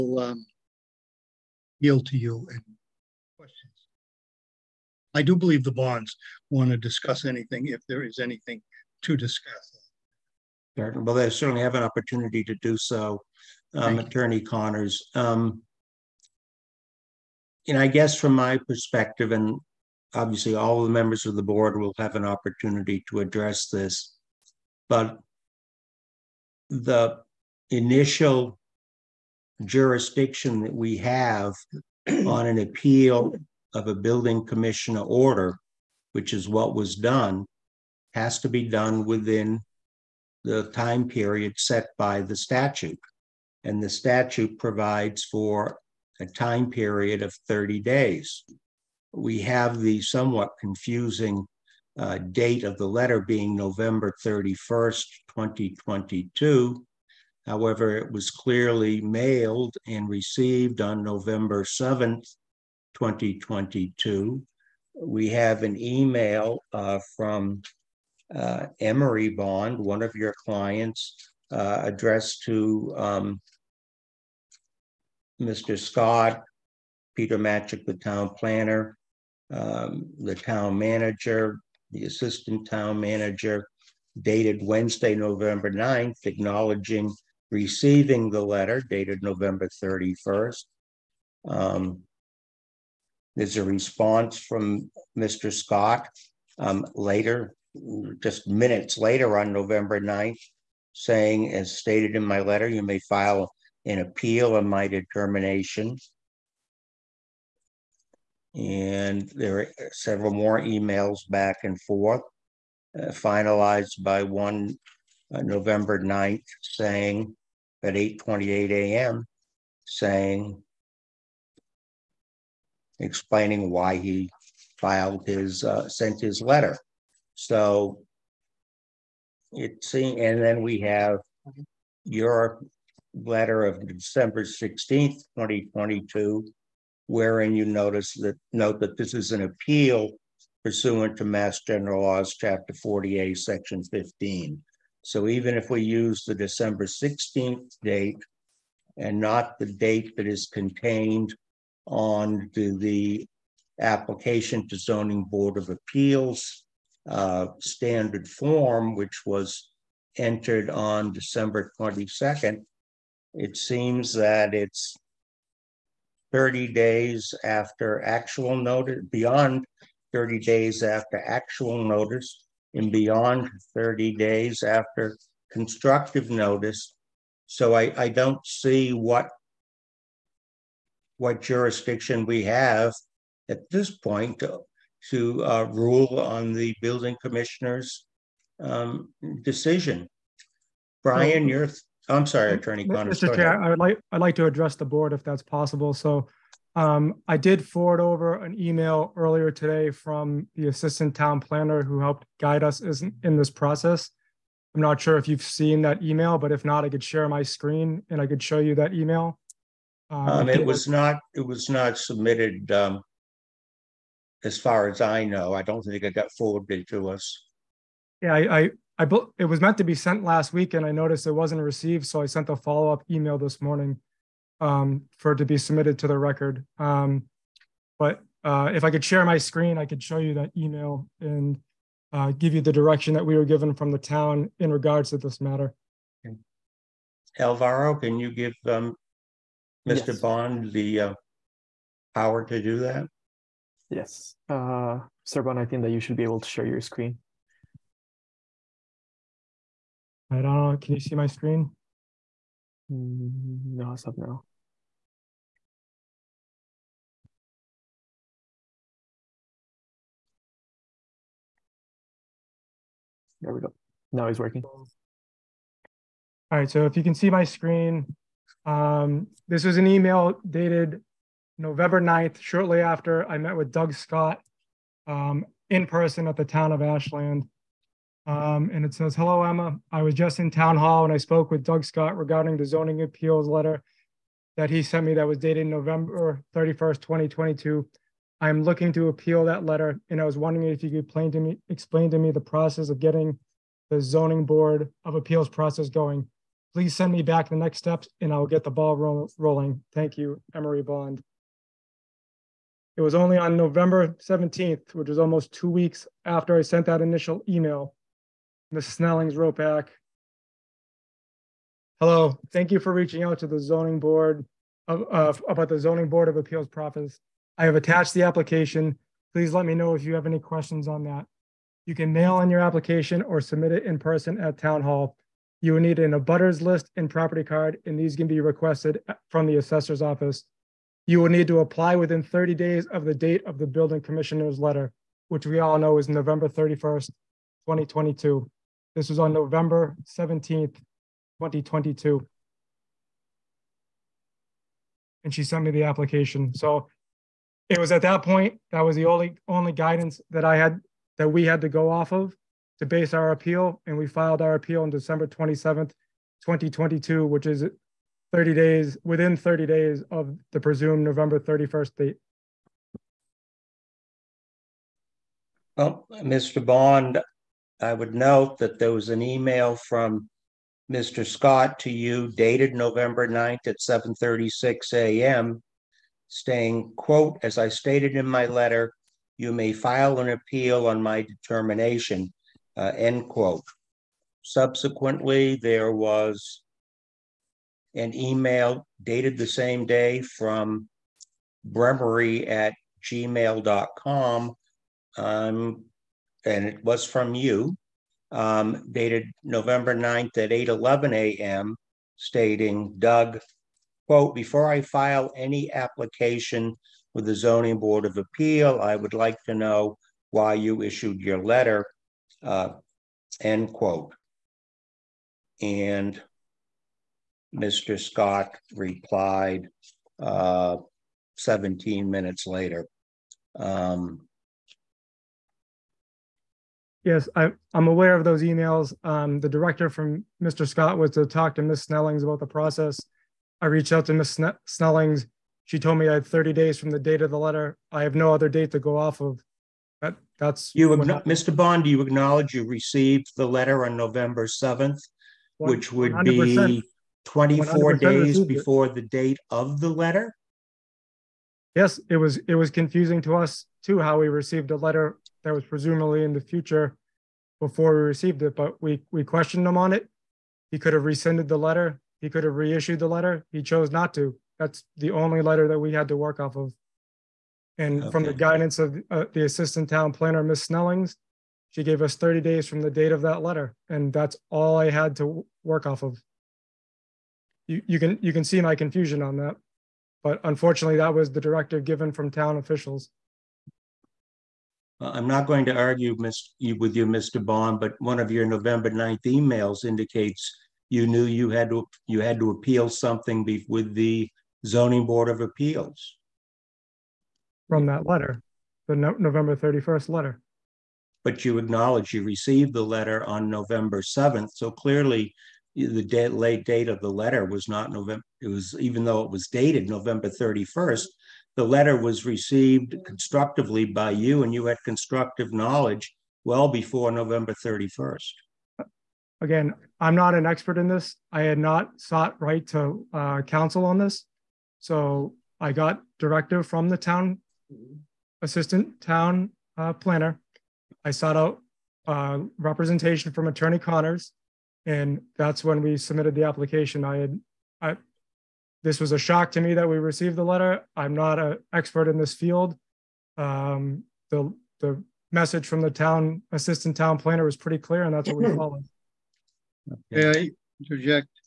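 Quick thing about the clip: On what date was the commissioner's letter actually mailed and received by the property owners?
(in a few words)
November 7th, 2022.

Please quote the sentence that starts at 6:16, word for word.
saying, quote, as I stated in my letter, you may file an appeal on my determination, uh, end quote.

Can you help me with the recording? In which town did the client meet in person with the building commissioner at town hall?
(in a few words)
Ashland.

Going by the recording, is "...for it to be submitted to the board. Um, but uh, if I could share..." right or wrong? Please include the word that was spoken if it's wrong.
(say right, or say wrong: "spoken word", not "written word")
wrong: "record", not "board".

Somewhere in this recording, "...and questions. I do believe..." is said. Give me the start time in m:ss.
0:02.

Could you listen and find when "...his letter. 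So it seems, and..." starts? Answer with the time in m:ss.
2:06.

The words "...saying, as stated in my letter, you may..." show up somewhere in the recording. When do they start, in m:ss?
1:40.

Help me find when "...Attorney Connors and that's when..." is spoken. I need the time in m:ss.
8:53.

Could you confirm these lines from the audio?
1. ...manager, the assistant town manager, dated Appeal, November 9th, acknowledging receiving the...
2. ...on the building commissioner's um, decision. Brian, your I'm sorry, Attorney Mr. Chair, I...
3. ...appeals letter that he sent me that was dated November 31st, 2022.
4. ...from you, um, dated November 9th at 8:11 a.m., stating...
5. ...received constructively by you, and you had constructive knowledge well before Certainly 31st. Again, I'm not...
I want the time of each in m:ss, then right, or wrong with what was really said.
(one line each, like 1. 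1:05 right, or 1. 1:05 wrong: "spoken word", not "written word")
1. 1:20 wrong: "Wednesday", not "Appeal"
2. 3:06 right
3. 4:43 right
4. 6:37 right
5. 8:32 wrong: "November", not "Certainly".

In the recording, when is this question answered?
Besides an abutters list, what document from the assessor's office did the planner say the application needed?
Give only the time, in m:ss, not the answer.
5:27.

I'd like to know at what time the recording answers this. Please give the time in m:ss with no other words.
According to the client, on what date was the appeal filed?
5:54.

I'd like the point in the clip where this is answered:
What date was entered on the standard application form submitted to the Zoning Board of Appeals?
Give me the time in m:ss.
2:41.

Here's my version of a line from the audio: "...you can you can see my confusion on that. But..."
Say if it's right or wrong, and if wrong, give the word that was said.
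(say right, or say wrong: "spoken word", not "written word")
right.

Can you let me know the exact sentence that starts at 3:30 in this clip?
Um, um, it was not it was not submitted um, as far as I know.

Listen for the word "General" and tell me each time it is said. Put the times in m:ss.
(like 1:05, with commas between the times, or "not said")
2:21.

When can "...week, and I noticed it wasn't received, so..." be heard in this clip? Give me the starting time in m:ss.
3:40.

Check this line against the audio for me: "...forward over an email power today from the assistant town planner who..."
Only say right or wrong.
wrong.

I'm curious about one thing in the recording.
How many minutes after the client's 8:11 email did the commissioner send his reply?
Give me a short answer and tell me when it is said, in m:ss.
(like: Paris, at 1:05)
17, at 7:01.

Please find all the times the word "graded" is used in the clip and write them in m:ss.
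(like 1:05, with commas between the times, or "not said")
not said.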